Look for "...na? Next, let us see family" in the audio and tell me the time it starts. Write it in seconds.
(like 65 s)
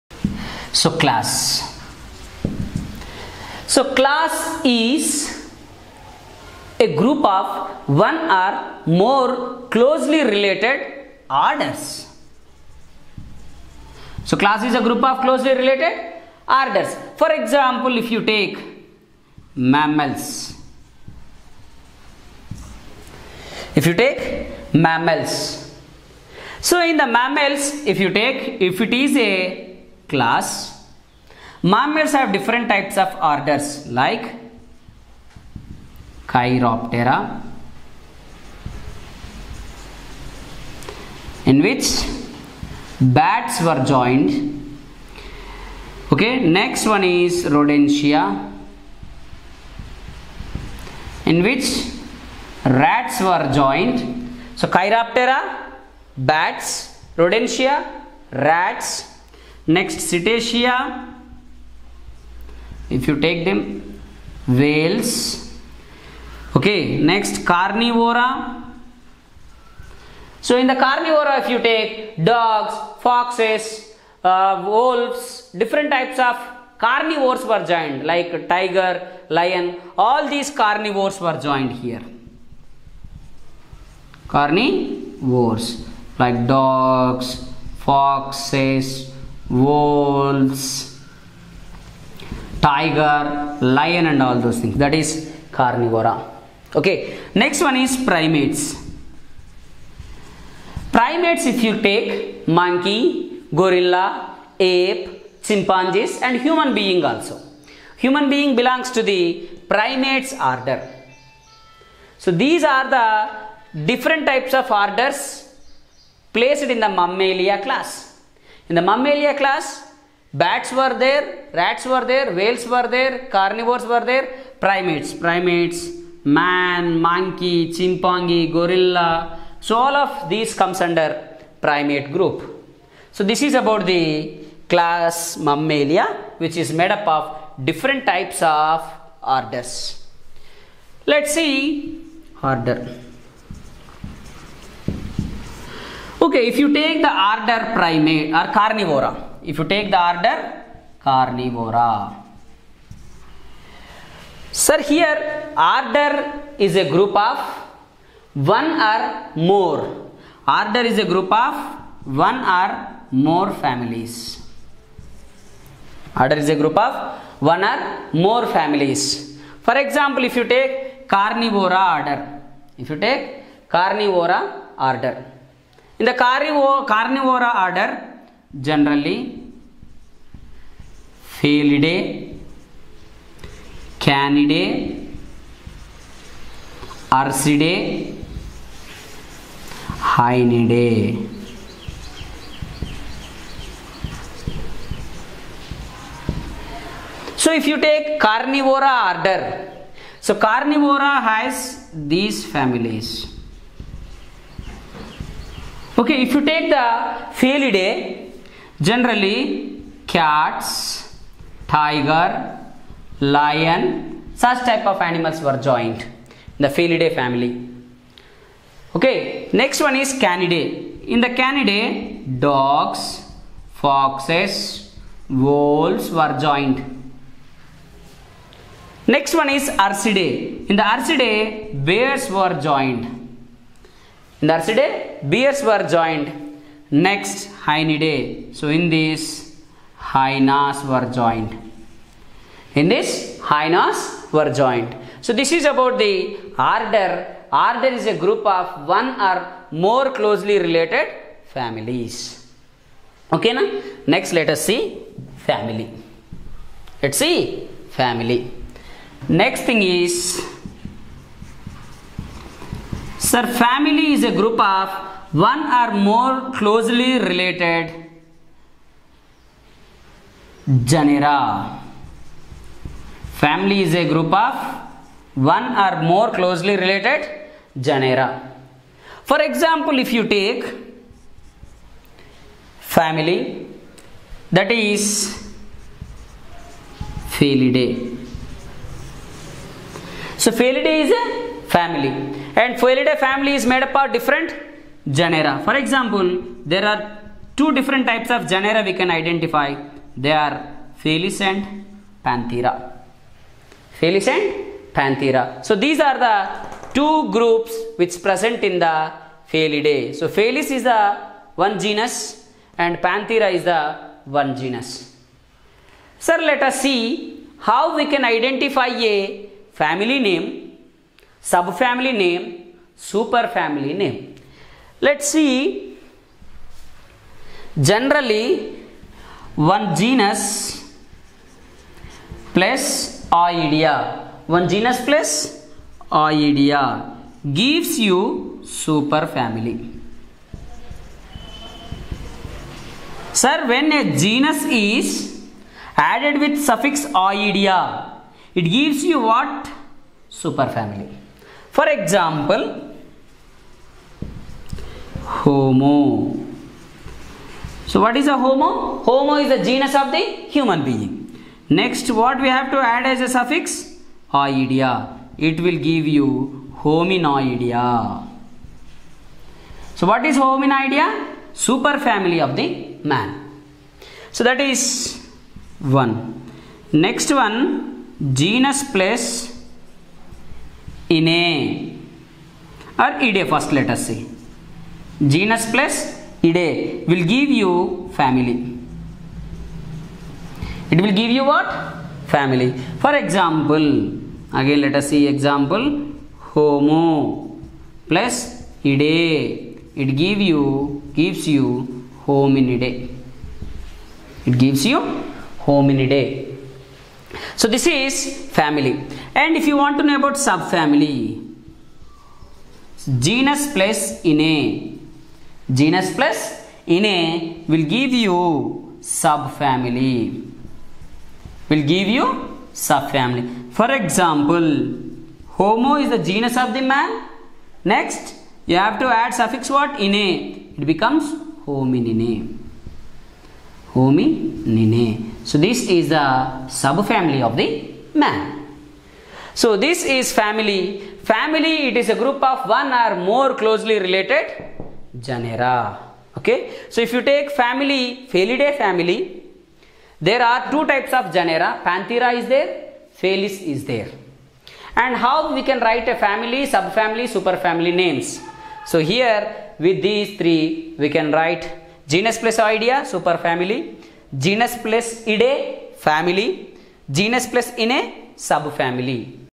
253 s.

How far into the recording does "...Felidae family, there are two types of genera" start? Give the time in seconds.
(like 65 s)
448 s.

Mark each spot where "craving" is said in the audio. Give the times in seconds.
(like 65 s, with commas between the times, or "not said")
not said.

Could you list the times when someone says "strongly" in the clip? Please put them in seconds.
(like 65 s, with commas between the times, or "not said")
not said.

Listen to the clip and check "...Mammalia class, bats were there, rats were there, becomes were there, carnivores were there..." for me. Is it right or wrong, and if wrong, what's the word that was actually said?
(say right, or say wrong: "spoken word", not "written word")
wrong: "whales", not "becomes".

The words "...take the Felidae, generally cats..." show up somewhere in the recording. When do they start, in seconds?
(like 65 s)
206 s.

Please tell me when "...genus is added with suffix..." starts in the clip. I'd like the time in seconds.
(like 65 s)
344 s.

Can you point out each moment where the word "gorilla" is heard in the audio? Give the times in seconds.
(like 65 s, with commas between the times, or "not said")
103 s, 128 s.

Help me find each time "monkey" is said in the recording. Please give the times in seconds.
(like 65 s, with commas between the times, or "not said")
102 s, 127 s.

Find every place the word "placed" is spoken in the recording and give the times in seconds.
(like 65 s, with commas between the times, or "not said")
116 s.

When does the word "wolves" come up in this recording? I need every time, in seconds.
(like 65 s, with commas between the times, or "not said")
74 s, 89 s, 225 s.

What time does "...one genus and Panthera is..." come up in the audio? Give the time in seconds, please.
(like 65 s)
311 s.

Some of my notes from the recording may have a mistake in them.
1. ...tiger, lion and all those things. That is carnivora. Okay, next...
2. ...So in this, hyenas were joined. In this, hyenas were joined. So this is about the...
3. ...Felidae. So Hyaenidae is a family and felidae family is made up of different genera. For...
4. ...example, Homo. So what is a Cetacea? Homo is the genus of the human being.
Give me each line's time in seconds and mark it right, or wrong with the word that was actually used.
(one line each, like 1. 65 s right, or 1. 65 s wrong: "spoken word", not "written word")
1. 92 s right
2. 238 s right
3. 287 s wrong: "Felidae", not "Hyaenidae"
4. 351 s wrong: "Homo", not "Cetacea".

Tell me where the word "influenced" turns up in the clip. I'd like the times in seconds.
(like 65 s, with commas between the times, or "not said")
not said.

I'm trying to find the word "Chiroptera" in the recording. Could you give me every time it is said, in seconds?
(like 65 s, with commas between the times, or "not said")
36 s, 54 s.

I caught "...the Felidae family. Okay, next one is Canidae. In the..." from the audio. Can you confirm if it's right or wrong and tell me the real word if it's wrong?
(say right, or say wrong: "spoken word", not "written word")
right.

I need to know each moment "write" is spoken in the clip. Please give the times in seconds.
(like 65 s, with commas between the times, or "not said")
455 s, 461 s.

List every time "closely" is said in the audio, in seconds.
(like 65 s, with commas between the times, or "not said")
9 s, 15 s, 250 s, 266 s, 276 s, 443 s.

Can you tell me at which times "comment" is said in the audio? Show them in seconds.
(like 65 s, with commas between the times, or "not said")
not said.